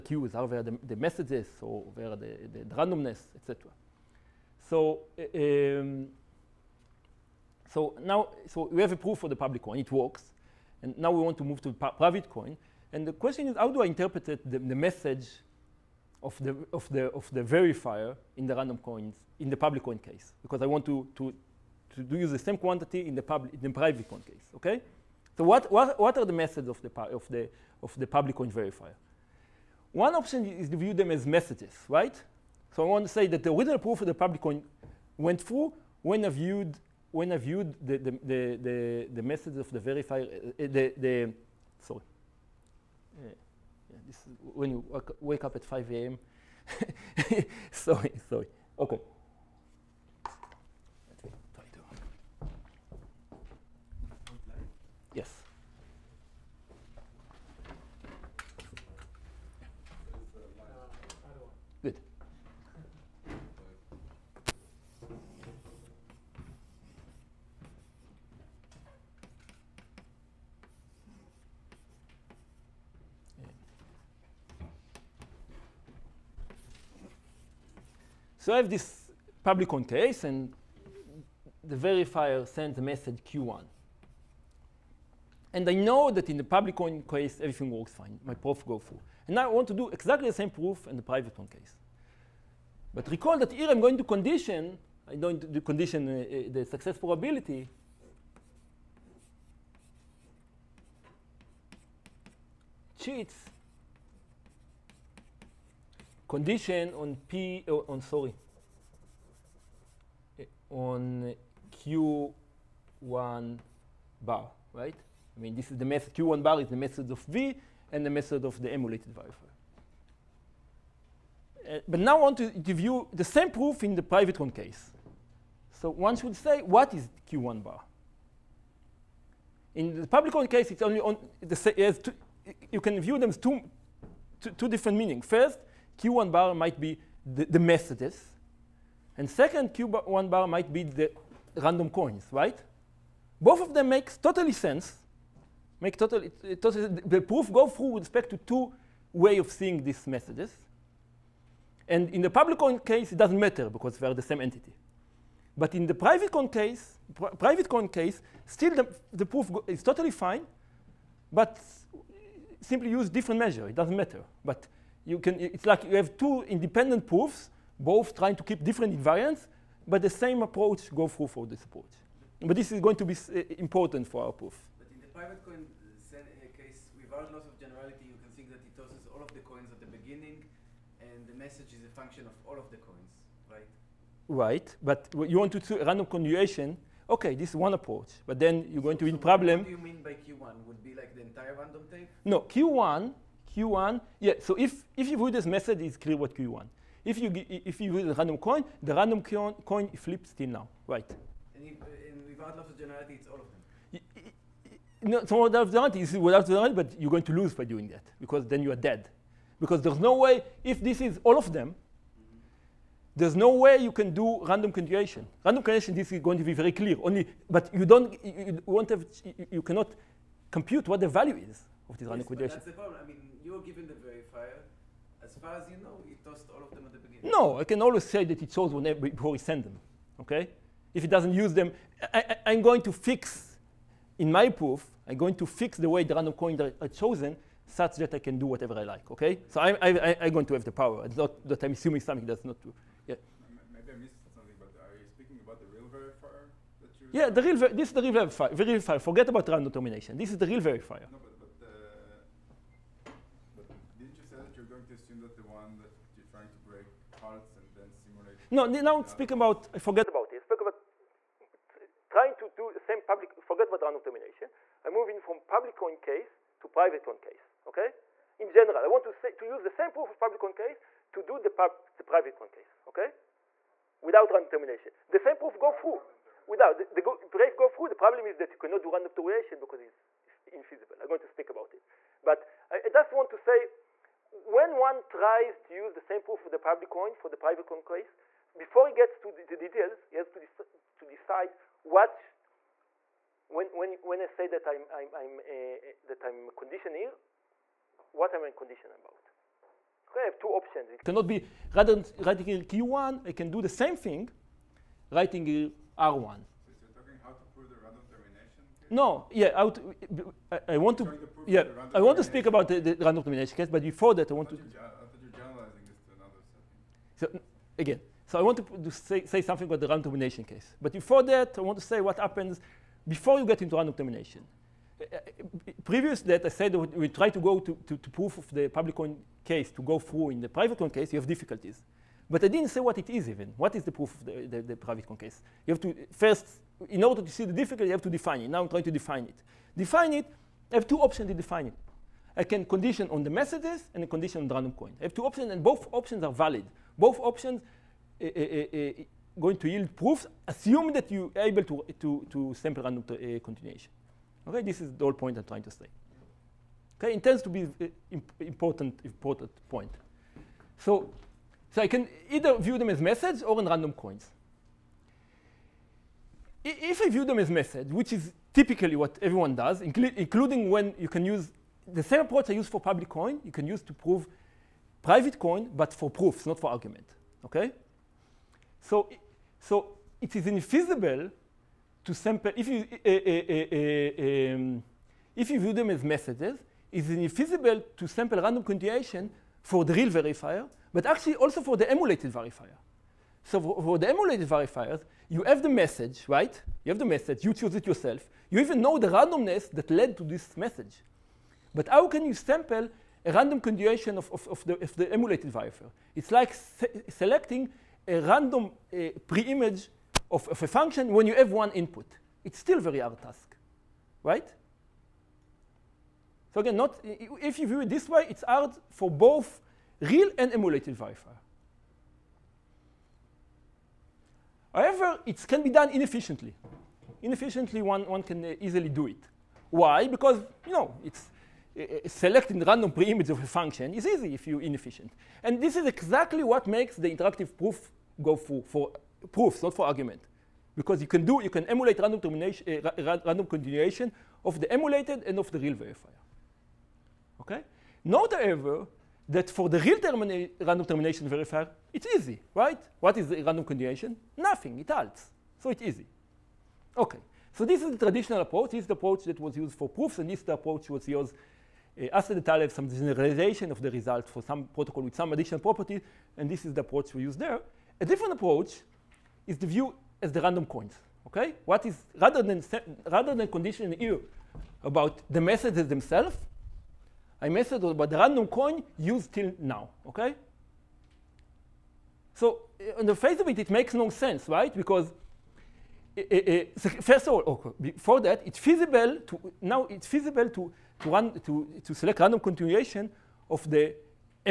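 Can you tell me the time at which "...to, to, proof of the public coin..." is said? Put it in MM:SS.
05:27.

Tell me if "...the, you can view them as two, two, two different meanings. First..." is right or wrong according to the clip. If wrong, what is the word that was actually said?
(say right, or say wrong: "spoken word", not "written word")
right.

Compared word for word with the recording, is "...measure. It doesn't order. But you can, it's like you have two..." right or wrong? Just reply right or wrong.
wrong.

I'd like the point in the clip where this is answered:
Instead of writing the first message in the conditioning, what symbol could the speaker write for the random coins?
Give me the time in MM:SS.
05:05.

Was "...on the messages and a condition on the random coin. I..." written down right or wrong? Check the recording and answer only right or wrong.
right.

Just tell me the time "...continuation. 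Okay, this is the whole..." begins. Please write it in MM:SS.
05:53.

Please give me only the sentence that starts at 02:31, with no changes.
And in the public coin case, it doesn't matter because they are the same entity.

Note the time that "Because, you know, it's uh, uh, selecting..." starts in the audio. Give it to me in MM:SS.
07:10.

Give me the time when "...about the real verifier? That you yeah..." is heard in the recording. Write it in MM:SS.
04:05.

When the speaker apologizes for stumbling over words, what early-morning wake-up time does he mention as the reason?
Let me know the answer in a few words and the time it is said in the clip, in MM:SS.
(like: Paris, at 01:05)
5 a.m., at 00:45.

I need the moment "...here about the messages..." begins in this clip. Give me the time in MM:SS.
07:53.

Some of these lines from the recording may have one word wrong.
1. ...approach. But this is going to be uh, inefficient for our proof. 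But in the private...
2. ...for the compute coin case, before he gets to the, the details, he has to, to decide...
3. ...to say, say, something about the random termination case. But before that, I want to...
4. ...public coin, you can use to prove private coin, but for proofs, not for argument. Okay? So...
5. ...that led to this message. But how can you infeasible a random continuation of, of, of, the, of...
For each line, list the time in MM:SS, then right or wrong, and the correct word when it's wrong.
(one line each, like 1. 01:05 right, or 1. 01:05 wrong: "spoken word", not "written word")
1. 02:51 wrong: "important", not "inefficient"
2. 04:47 wrong: "private", not "compute"
3. 05:18 right
4. 06:12 right
5. 06:39 wrong: "sample", not "infeasible".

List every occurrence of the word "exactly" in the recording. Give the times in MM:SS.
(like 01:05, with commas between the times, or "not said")
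01:29, 07:15.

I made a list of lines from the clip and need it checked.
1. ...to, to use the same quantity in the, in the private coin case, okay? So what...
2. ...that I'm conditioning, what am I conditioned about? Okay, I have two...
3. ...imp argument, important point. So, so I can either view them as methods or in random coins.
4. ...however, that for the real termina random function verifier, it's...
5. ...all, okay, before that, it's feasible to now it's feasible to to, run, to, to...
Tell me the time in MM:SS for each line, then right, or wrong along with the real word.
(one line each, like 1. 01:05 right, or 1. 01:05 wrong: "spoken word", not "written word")
1. 00:21 right
2. 04:56 right
3. 05:58 wrong: "important", not "argument"
4. 07:28 wrong: "termination", not "function"
5. 08:07 right.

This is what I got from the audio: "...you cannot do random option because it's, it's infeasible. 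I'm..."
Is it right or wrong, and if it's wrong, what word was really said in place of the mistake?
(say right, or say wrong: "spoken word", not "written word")
wrong: "termination", not "option".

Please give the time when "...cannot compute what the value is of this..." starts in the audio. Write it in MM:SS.
03:39.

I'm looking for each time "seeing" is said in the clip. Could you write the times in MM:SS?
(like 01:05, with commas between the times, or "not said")
02:29.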